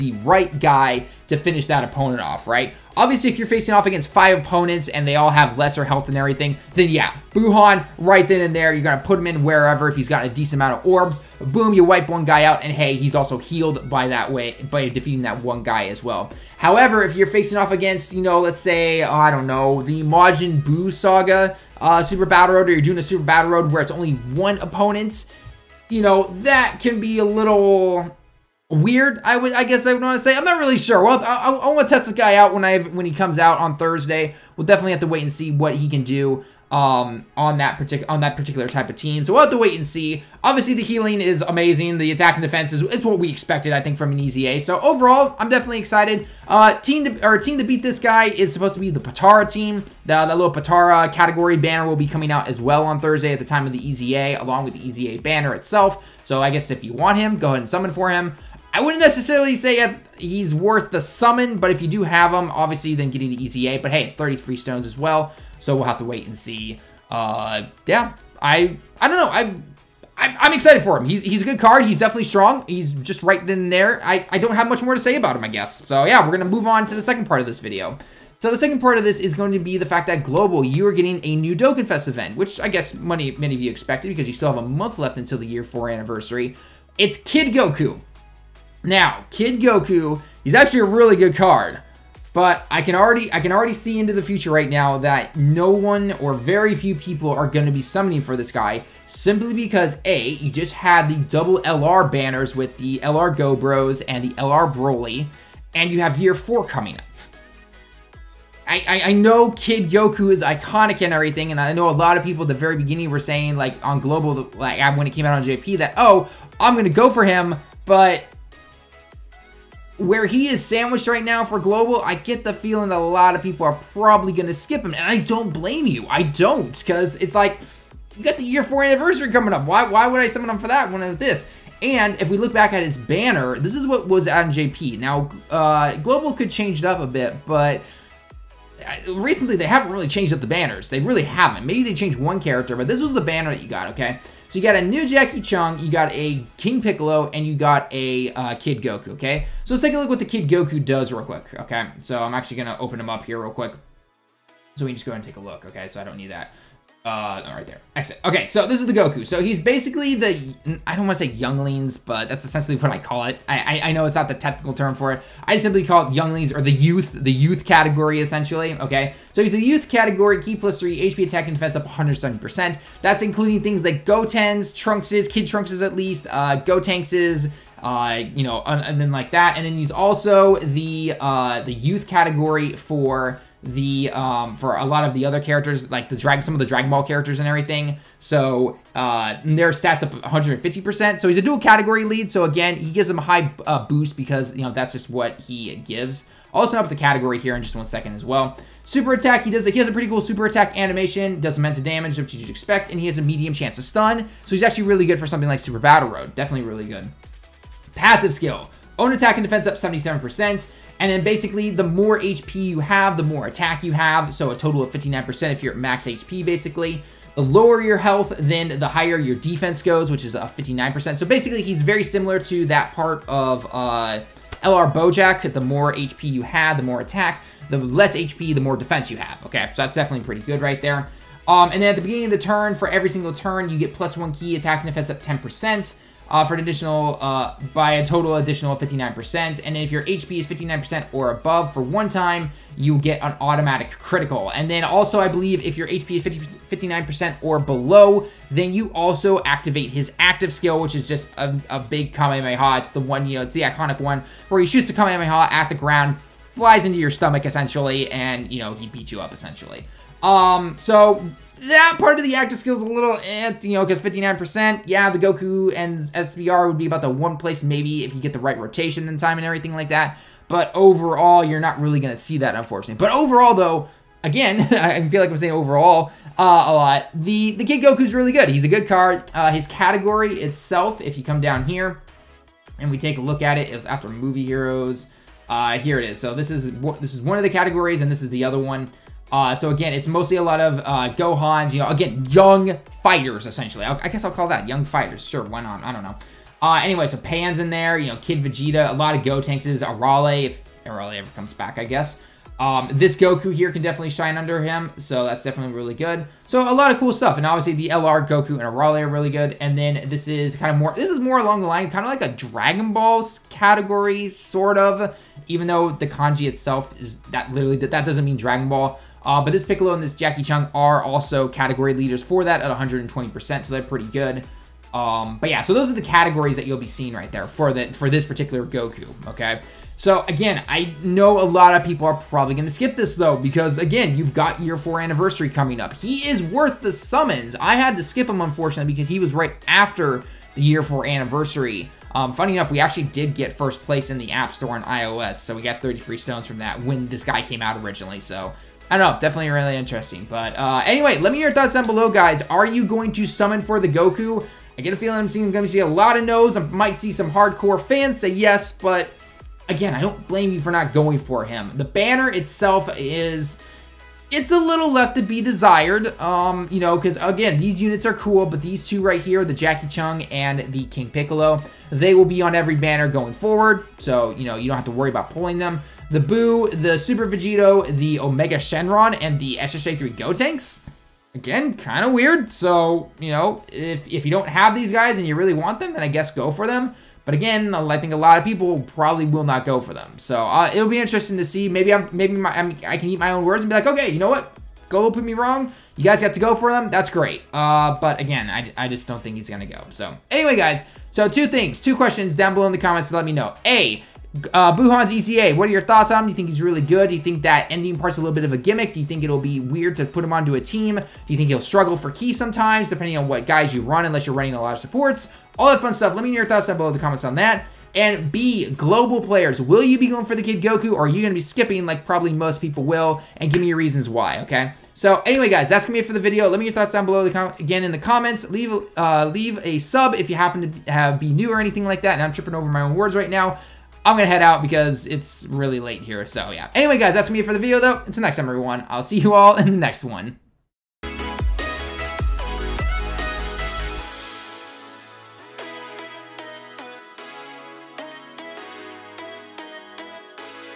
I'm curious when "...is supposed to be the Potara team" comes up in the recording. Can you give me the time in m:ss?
0:48.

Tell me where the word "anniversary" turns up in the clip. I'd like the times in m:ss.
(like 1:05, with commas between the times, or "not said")
1:25, 2:08, 5:35, 5:41.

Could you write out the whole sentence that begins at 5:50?
But uh, anyway, let me hear your thoughts down below, guys.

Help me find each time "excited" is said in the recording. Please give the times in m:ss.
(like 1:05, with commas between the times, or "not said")
0:45, 1:10.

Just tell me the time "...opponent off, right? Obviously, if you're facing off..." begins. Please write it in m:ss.
0:01.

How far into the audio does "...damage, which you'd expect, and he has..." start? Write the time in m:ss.
3:21.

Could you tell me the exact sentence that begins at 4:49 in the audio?
Uh, so again, it's mostly a lot of uh, Gohans, you know, again, young fighters, essentially.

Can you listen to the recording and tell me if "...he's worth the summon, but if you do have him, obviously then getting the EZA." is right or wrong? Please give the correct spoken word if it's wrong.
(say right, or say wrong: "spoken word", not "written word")
right.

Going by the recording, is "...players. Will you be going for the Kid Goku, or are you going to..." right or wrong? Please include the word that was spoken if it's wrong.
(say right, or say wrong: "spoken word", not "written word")
right.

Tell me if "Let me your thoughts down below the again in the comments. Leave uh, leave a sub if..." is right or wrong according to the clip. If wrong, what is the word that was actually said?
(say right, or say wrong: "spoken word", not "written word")
right.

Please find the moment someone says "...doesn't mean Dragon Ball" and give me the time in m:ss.
5:18.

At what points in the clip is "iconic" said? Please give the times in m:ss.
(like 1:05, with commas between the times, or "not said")
1:50, 4:13.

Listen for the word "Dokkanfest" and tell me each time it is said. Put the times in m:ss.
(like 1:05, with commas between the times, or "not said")
1:21.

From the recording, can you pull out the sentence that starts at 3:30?
And then basically, the more HP you have, the more attack you have.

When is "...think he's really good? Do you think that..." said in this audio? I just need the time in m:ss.
6:46.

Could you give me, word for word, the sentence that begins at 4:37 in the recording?
The the Kid Goku's really good.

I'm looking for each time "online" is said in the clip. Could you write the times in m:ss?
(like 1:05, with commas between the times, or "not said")
not said.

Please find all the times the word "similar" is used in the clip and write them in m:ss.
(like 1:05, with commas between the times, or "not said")
3:42.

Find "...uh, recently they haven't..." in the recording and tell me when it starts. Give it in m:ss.
2:18.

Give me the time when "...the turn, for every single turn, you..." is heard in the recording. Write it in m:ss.
3:52.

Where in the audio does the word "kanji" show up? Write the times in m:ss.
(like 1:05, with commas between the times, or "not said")
5:16.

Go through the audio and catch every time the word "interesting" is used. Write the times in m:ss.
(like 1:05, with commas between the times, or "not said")
5:49, 6:30.